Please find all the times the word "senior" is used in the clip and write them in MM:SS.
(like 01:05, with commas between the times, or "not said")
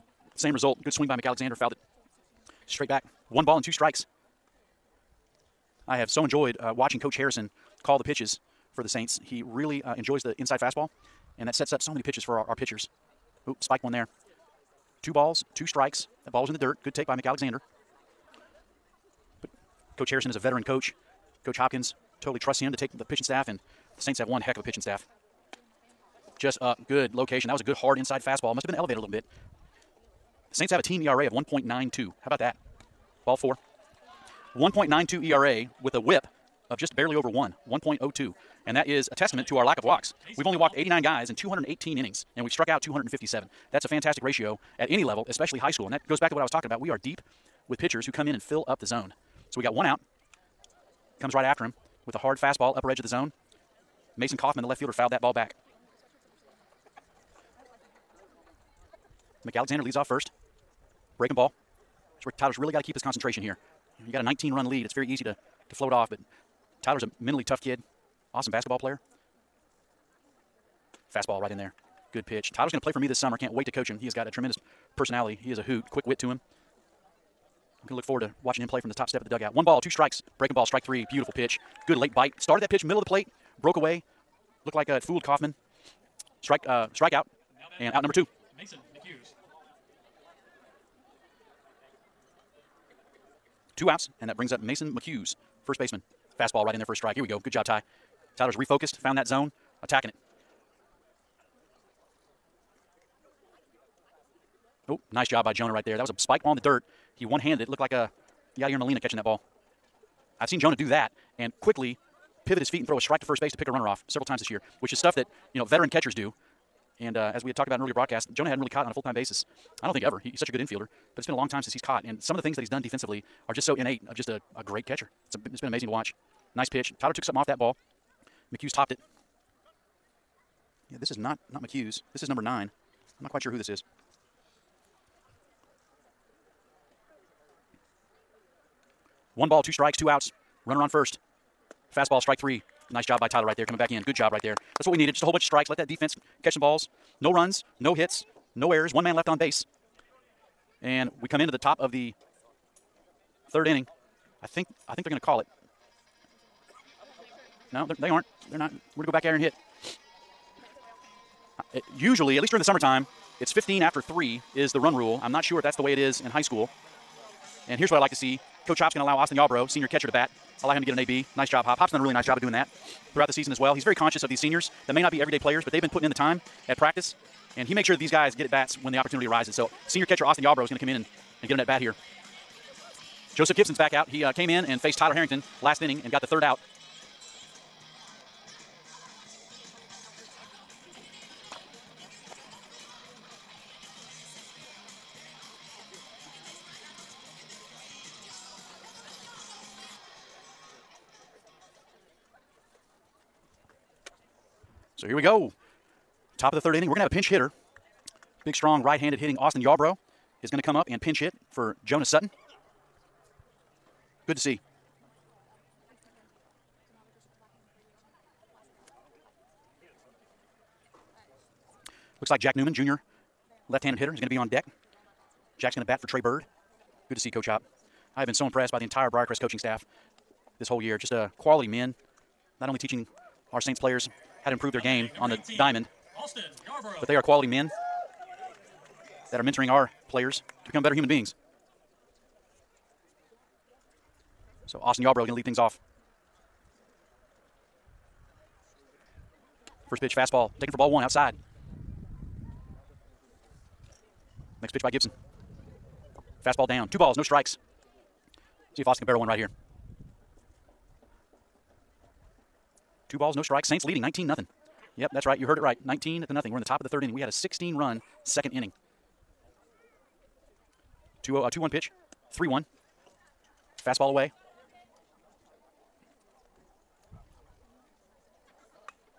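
02:49, 02:54, 02:59.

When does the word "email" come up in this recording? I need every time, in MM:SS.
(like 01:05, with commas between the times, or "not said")
not said.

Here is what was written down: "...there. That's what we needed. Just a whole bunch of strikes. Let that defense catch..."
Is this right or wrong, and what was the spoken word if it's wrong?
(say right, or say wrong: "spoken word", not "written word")
right.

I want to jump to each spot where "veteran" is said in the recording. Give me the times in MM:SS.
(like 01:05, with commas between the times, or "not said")
00:20, 01:55.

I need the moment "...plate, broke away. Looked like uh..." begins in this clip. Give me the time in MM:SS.
01:23.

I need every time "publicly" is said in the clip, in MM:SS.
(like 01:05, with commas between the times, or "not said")
not said.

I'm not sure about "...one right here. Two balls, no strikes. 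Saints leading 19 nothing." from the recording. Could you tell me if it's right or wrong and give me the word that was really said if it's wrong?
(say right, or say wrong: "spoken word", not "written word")
right.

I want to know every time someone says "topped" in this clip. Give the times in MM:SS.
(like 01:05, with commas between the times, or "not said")
02:08.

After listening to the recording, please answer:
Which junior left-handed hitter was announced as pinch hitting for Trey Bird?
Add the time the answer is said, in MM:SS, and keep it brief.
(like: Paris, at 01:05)
Jack Newman, at 03:42.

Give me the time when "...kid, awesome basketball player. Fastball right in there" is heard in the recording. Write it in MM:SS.
01:07.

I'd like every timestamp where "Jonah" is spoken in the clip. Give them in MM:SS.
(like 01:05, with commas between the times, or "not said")
01:45, 01:50, 01:58, 03:31.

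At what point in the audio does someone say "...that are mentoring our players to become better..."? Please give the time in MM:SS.
03:59.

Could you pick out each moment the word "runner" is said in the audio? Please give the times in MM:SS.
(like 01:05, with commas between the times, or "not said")
01:53, 02:20.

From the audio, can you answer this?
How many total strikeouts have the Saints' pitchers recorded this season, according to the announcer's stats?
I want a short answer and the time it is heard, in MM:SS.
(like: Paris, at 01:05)
257, at 00:42.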